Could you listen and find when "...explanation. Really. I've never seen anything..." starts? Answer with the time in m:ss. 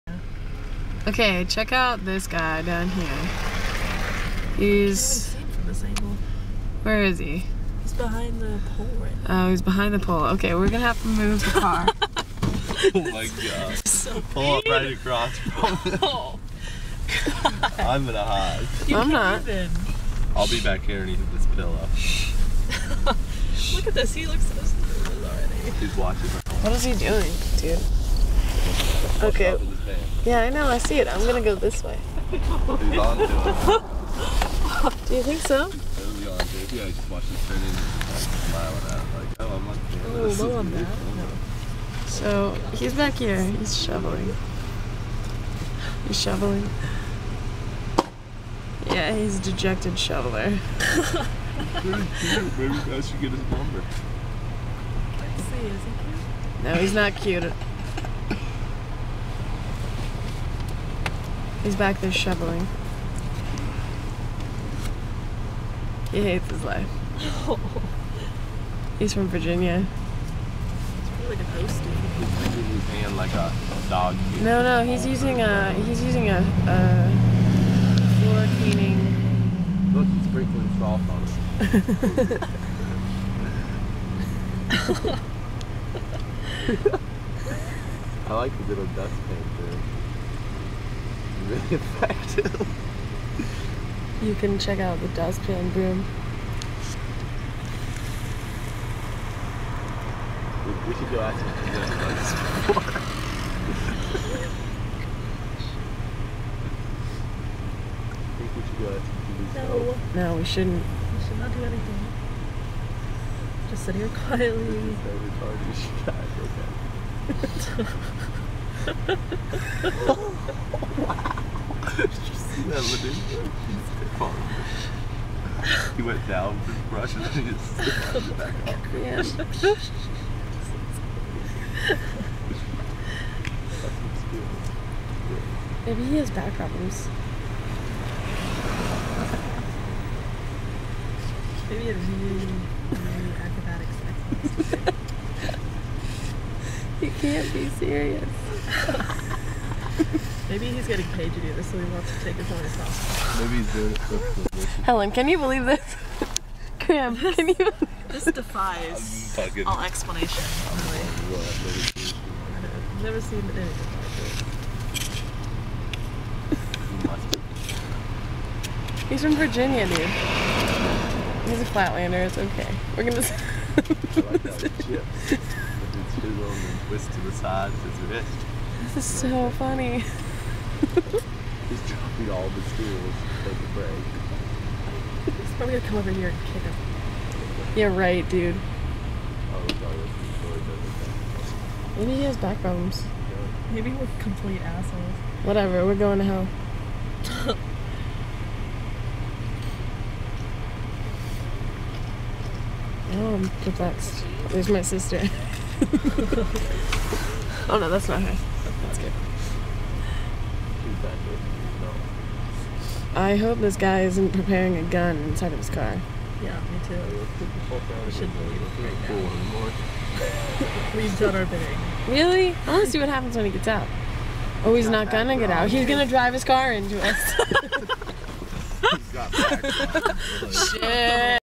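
2:39.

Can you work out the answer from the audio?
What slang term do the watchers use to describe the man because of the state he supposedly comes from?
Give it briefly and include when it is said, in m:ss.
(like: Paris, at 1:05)
flatlander, at 2:51.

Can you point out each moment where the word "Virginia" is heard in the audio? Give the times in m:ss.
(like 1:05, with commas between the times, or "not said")
1:09, 2:49.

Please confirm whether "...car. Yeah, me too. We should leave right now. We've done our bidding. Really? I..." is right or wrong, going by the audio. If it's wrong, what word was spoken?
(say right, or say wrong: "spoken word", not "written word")
right.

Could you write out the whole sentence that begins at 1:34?
you can check out the dustpan broom.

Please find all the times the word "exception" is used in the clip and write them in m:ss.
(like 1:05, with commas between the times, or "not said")
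not said.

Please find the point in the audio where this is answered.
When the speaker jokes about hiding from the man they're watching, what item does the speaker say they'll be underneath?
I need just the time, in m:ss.
0:21.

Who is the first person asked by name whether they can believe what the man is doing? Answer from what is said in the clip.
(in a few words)
Helen.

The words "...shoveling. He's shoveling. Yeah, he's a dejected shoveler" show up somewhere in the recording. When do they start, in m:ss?
0:43.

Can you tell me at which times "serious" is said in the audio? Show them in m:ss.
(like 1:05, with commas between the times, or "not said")
2:27.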